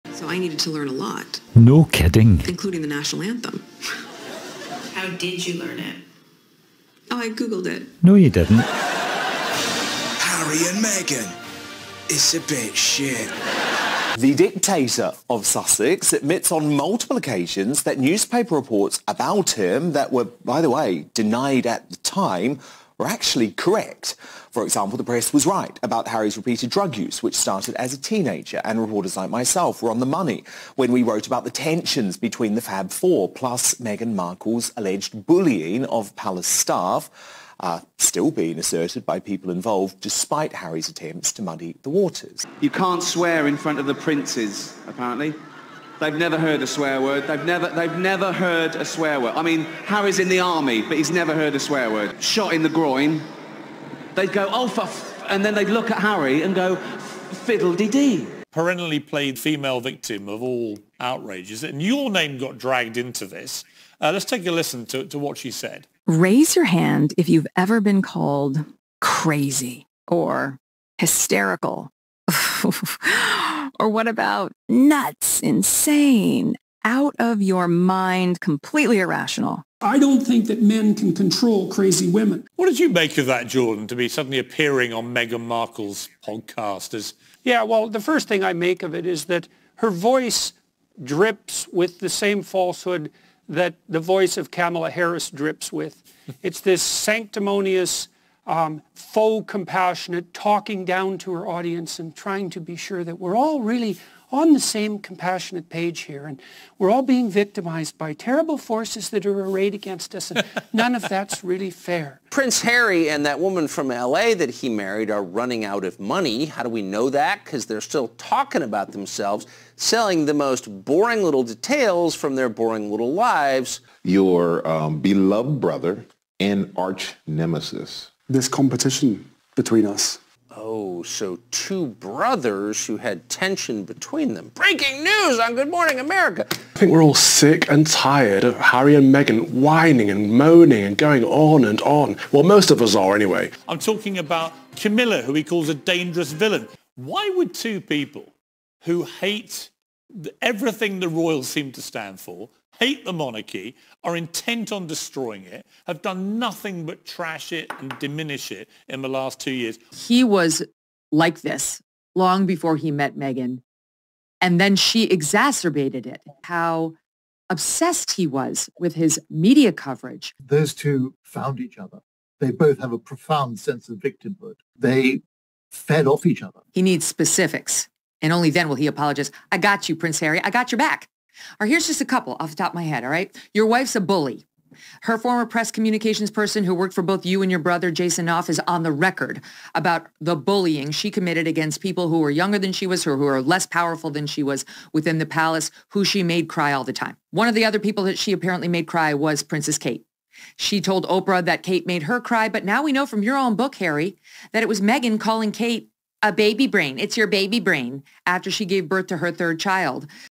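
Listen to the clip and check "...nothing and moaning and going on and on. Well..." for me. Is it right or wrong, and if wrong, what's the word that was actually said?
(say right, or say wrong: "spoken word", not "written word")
wrong: "whining", not "nothing".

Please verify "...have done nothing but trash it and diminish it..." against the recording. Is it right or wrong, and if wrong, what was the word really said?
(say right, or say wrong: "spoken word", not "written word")
right.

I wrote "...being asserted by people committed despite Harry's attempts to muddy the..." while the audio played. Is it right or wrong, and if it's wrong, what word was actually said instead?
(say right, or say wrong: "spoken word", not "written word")
wrong: "involved", not "committed".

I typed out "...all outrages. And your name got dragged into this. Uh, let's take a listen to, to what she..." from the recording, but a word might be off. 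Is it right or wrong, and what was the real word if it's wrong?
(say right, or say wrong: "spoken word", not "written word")
right.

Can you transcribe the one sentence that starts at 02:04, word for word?
Your um, beloved brother and arch nemesis this competition between us.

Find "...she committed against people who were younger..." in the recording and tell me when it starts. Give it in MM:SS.
03:10.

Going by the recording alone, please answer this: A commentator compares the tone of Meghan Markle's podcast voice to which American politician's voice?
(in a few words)
Kamala Harris.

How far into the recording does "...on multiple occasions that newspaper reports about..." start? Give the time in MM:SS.
00:16.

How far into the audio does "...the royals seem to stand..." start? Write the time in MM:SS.
02:30.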